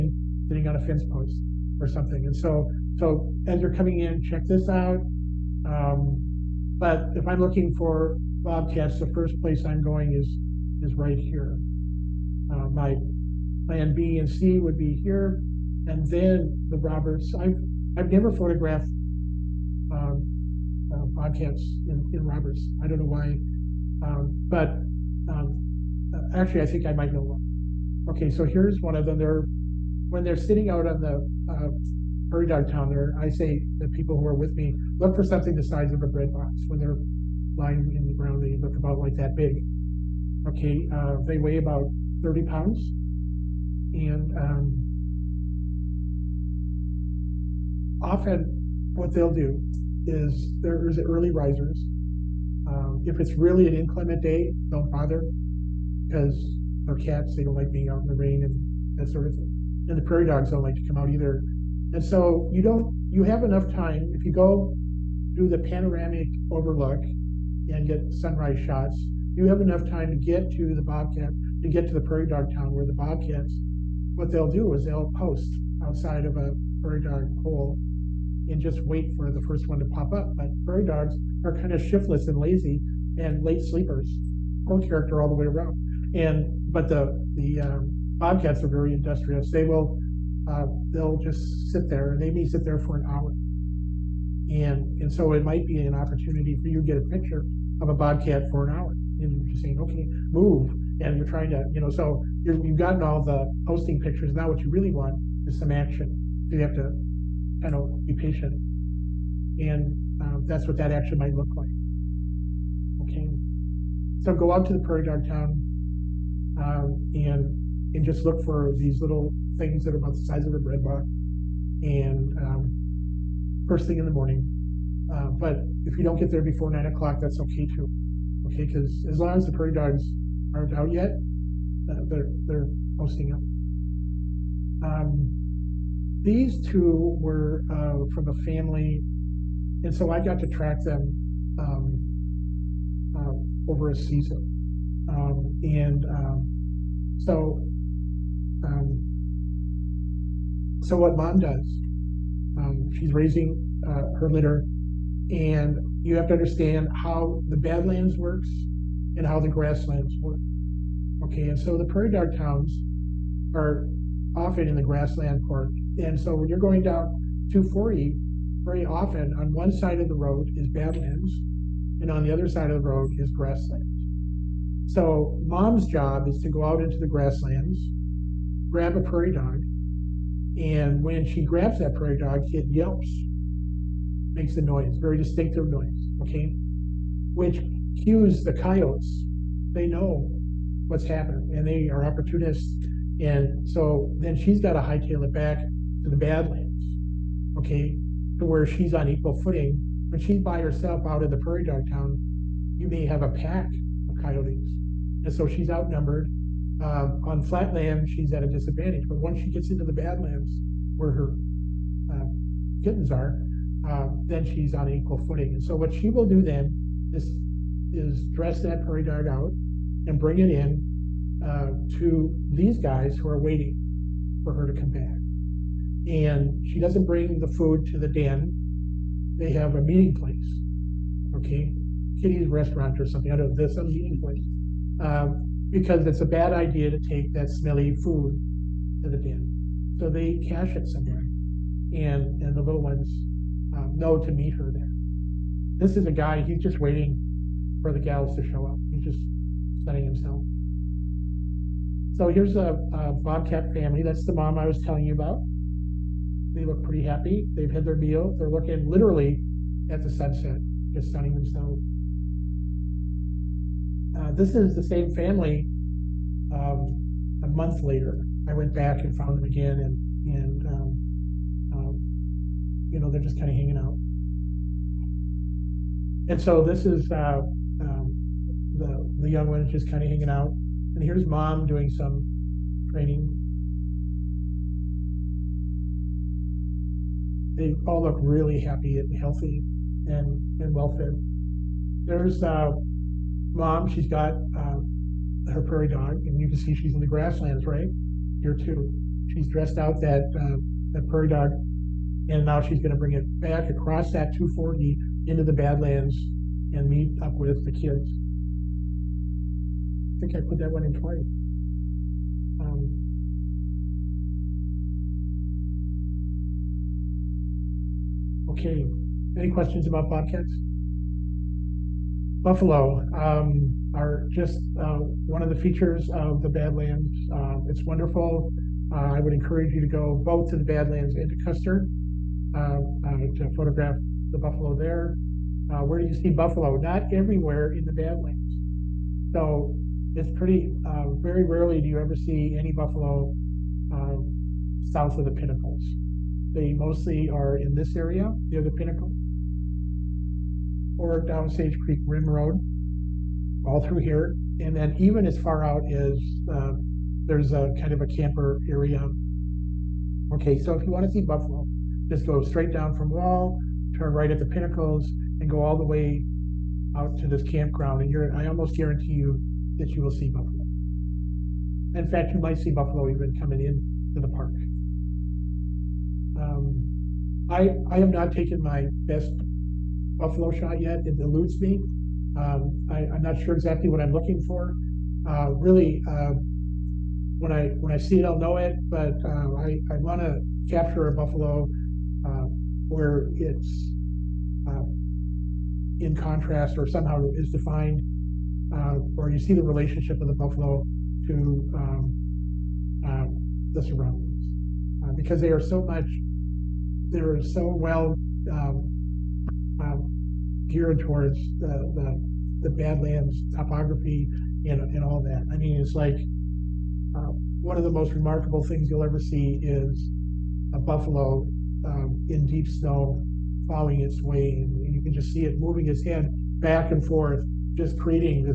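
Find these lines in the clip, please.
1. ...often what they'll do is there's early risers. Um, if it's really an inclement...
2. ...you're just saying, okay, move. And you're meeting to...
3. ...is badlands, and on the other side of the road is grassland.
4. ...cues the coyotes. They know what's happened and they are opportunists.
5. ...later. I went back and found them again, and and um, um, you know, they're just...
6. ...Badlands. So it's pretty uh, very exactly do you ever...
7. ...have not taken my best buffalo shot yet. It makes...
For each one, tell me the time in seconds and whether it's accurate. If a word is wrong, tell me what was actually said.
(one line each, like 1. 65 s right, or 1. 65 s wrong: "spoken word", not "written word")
1. 48 s right
2. 99 s wrong: "trying", not "meeting"
3. 170 s right
4. 188 s right
5. 267 s right
6. 337 s wrong: "rarely", not "exactly"
7. 377 s wrong: "eludes", not "makes".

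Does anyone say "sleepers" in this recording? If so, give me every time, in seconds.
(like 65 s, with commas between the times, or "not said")
83 s.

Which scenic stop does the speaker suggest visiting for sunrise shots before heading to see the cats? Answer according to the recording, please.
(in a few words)
Panoramic overlook.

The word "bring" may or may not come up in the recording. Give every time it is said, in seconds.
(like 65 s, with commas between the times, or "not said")
220 s, 227 s, 302 s.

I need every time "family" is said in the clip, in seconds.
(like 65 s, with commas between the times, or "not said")
138 s, 253 s, 265 s.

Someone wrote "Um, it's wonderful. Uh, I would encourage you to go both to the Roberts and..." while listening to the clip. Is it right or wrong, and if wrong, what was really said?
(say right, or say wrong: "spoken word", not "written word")
wrong: "Badlands", not "Roberts".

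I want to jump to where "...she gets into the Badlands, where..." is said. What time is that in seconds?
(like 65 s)
209 s.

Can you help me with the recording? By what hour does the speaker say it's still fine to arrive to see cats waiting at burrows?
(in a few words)
9 o'clock.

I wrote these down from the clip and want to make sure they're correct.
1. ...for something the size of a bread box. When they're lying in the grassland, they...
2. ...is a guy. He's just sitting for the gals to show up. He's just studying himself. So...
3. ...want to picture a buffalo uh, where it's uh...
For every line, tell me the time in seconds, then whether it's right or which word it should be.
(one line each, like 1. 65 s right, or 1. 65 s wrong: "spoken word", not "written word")
1. 35 s wrong: "ground", not "grassland"
2. 245 s wrong: "waiting", not "sitting"
3. 389 s wrong: "capture", not "picture".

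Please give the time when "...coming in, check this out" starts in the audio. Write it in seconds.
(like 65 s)
3 s.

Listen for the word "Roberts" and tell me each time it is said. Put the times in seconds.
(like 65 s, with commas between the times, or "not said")
16 s, 22 s.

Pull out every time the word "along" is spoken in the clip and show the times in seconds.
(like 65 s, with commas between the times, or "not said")
not said.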